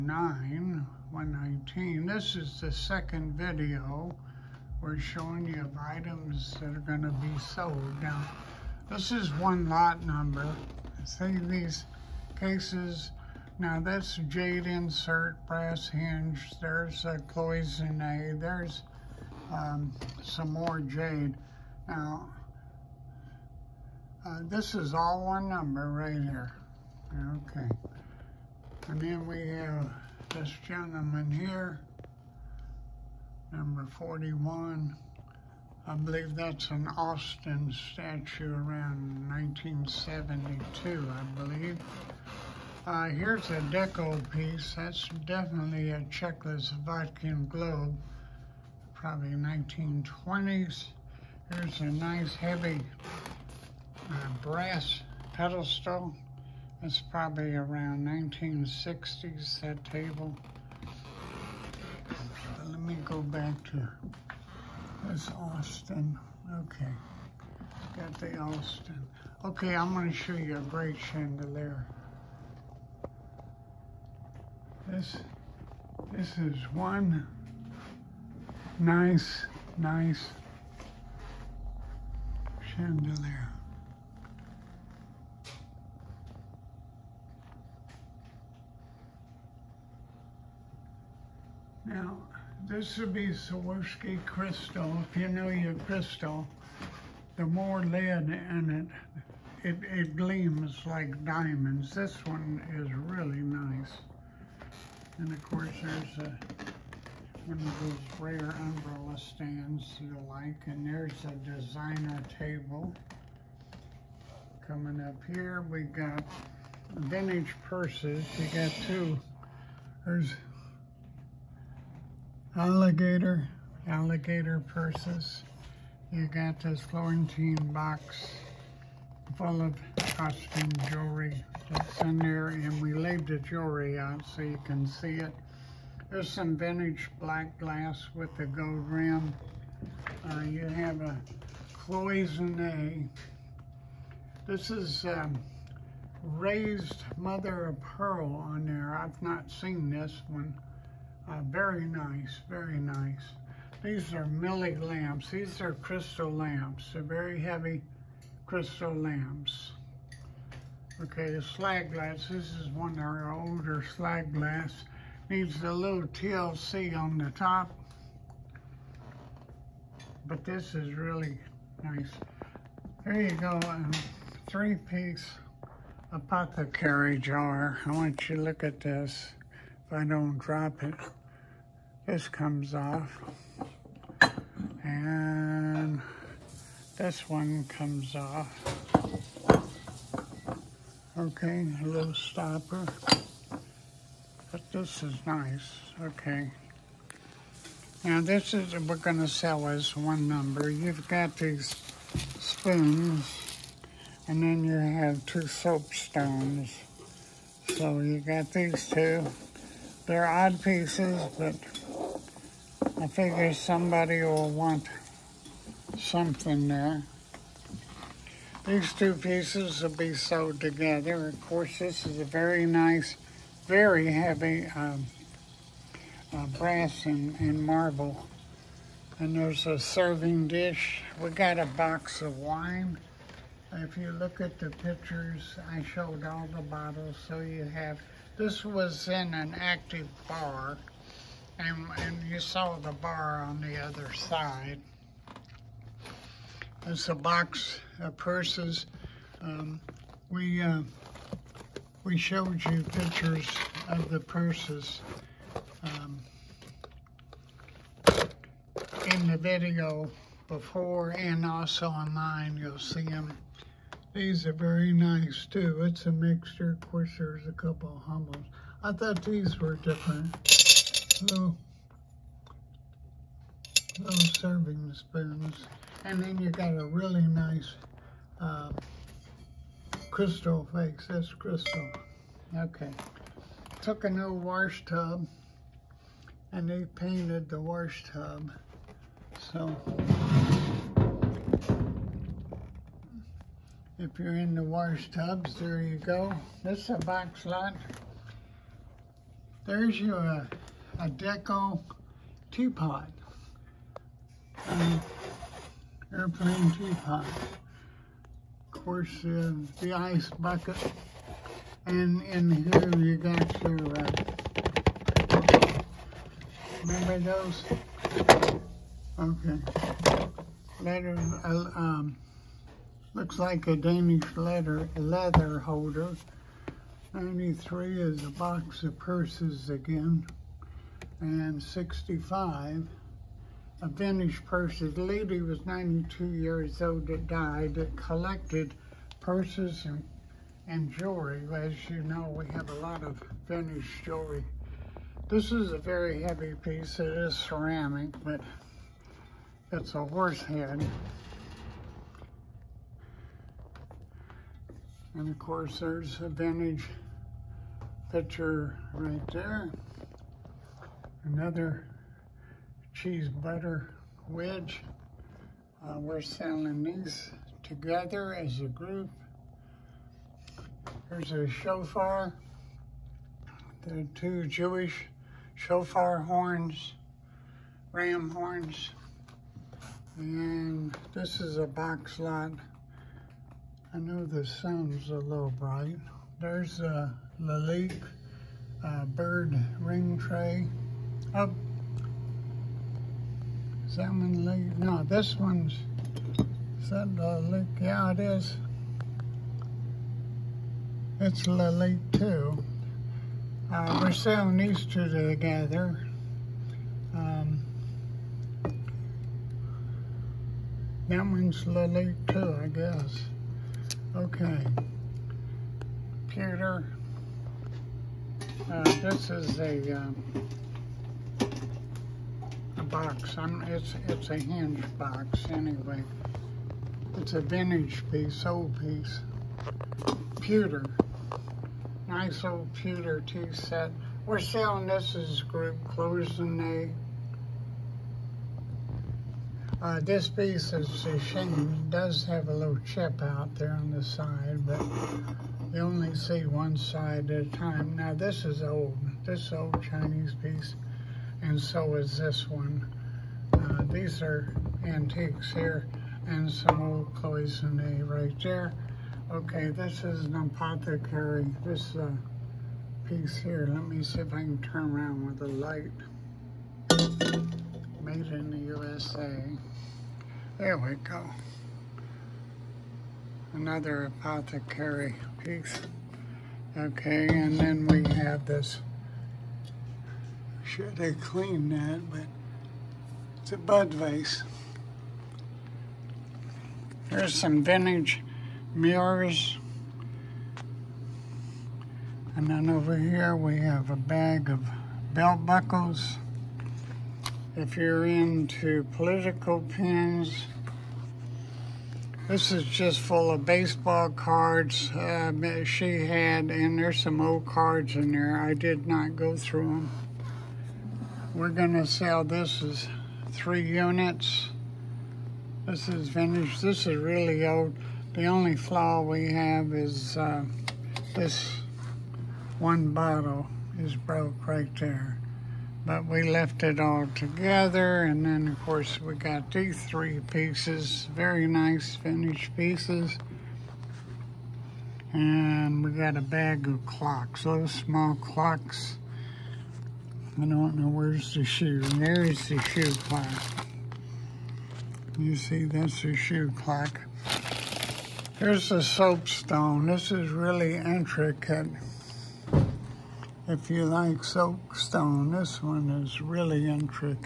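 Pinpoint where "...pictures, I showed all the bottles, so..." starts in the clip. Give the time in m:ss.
3:54.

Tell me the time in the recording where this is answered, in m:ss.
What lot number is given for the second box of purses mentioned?
5:27.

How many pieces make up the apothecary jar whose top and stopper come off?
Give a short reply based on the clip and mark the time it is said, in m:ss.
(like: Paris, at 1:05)
3, at 2:54.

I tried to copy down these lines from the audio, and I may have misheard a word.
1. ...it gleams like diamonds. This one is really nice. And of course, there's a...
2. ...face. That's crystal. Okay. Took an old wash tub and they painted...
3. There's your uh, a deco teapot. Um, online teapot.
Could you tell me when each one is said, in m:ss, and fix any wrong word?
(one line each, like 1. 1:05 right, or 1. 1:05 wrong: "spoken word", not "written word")
1. 1:39 right
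2. 4:40 right
3. 4:59 wrong: "airplane", not "online".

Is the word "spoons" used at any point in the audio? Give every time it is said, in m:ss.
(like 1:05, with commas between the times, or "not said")
3:22, 4:34.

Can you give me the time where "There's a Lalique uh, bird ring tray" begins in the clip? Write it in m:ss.
6:26.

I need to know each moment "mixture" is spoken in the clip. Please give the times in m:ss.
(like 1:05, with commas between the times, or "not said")
4:26.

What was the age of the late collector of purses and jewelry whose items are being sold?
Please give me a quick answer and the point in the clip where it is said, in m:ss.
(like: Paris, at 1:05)
92, at 5:35.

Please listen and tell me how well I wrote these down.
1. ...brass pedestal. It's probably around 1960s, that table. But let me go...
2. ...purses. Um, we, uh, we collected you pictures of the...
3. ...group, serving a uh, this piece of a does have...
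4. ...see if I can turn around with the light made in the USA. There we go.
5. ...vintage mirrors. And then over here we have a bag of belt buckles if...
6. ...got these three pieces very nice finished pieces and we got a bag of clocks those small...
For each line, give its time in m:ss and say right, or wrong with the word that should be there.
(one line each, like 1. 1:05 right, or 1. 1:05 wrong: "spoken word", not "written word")
1. 0:54 right
2. 4:08 wrong: "showed", not "collected"
3. 7:15 wrong: "closing", not "serving"
4. 7:44 right
5. 8:07 right
6. 8:49 right.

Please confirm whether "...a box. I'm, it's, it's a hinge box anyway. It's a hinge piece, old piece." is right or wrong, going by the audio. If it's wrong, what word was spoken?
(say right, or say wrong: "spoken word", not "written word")
wrong: "vintage", not "hinge".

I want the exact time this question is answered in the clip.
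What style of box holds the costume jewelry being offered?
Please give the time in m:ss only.
2:06.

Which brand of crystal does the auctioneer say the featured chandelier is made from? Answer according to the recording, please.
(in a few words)
Swarovski.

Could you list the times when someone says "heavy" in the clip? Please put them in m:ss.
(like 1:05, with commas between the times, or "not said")
0:52, 2:37, 3:44, 5:46.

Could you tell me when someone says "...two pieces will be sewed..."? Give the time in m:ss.
3:38.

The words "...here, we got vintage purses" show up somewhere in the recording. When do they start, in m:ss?
1:55.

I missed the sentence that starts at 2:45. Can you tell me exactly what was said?
Needs a little TLC on the top.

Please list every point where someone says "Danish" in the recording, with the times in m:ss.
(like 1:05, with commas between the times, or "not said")
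5:23, 5:33, 5:43.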